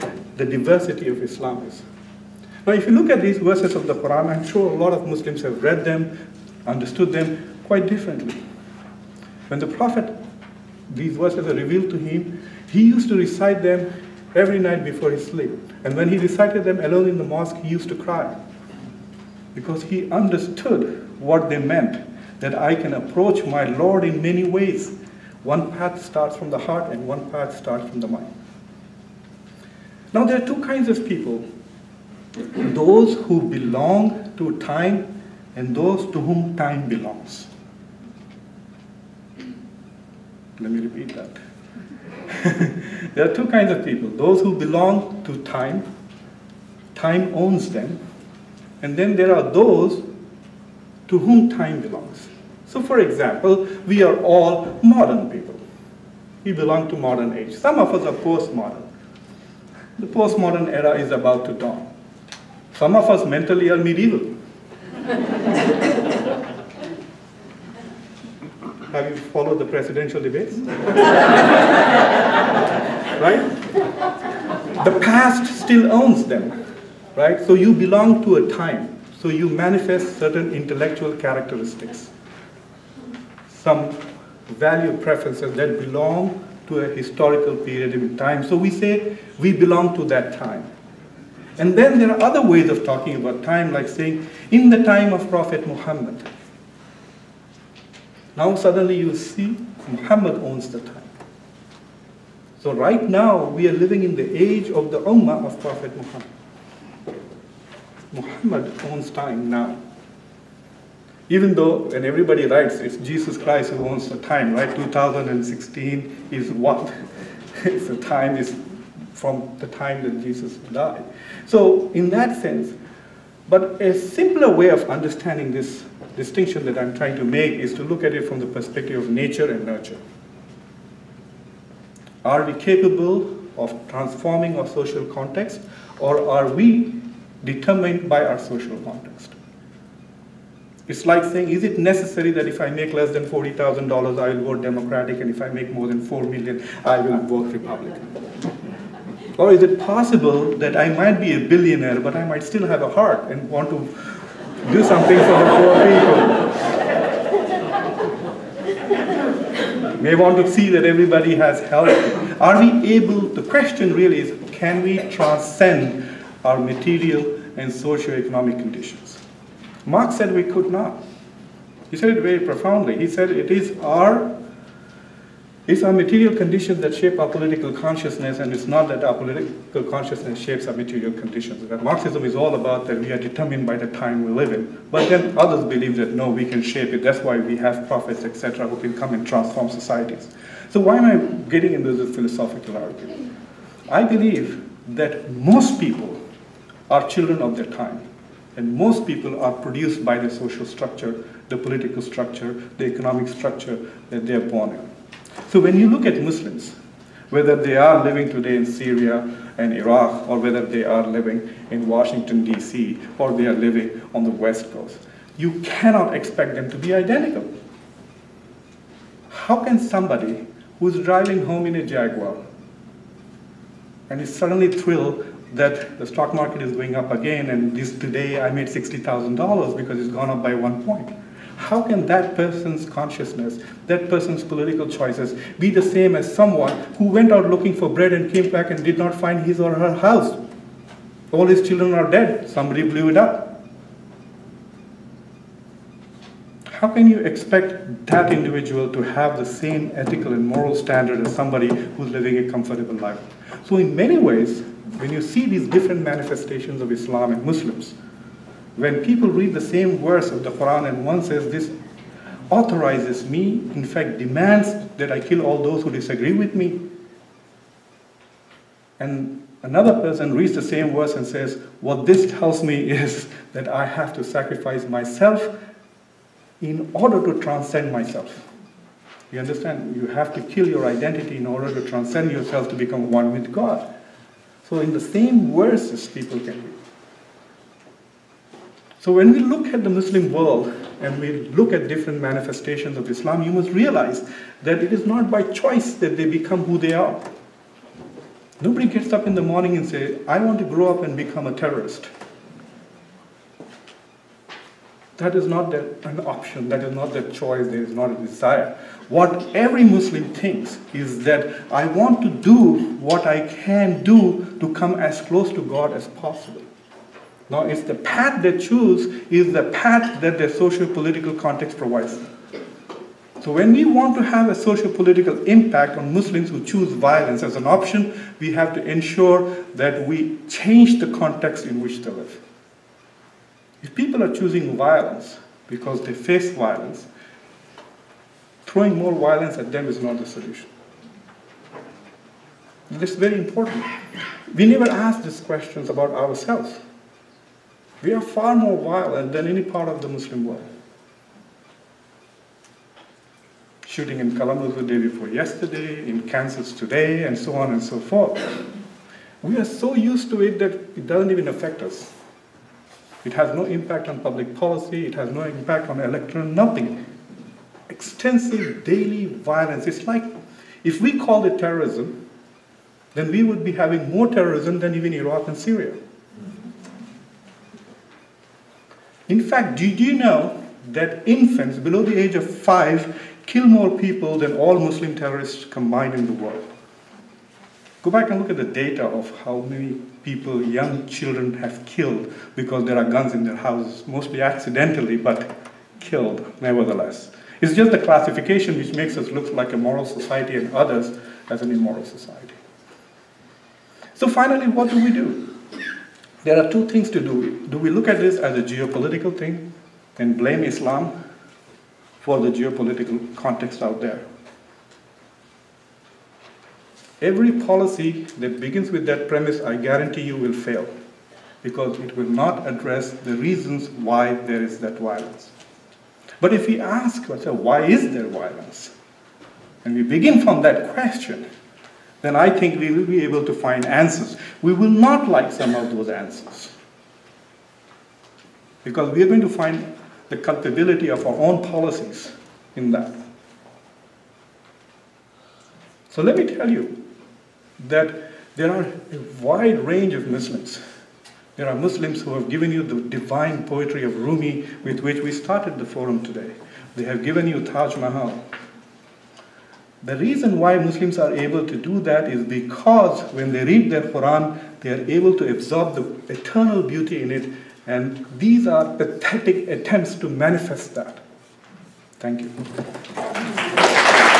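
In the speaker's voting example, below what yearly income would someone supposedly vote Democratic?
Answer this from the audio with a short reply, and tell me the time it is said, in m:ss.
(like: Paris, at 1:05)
$40,000, at 2:23.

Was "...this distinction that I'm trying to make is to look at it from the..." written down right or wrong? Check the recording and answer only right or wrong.
right.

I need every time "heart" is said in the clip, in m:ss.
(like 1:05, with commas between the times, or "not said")
0:26, 2:32.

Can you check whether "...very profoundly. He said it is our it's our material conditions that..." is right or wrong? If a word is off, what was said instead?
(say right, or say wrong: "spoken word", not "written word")
right.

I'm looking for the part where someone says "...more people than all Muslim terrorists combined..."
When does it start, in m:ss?
6:23.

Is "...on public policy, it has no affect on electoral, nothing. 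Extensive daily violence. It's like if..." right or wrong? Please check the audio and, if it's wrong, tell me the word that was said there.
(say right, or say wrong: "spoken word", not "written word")
wrong: "impact", not "affect".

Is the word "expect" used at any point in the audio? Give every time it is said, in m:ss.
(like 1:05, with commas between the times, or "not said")
3:36, 4:07.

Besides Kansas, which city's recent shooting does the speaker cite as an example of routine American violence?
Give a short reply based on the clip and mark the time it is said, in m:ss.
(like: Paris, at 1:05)
Kalamazoo, at 5:54.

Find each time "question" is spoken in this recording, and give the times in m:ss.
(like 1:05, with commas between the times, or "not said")
2:43, 5:45, 7:10.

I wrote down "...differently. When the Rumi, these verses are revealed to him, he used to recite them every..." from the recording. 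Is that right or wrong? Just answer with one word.
wrong.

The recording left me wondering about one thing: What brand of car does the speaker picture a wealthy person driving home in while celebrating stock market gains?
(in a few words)
Jaguar.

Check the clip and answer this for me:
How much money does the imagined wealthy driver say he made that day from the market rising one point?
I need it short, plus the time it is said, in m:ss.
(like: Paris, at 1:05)
$60,000, at 3:48.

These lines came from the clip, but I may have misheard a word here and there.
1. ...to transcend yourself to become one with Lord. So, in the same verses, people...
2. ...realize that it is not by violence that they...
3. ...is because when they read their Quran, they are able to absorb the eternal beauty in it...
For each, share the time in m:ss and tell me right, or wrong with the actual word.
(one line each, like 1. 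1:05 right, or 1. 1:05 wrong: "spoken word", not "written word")
1. 4:41 wrong: "God", not "Lord"
2. 4:53 wrong: "choice", not "violence"
3. 7:42 right.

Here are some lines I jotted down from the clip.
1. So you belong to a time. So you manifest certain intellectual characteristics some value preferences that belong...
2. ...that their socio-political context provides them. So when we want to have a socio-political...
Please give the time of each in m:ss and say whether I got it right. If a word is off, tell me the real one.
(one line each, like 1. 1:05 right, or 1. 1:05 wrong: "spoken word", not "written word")
1. 1:17 right
2. 5:20 right.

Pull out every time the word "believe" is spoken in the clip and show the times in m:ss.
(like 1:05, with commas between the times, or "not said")
3:05, 3:14.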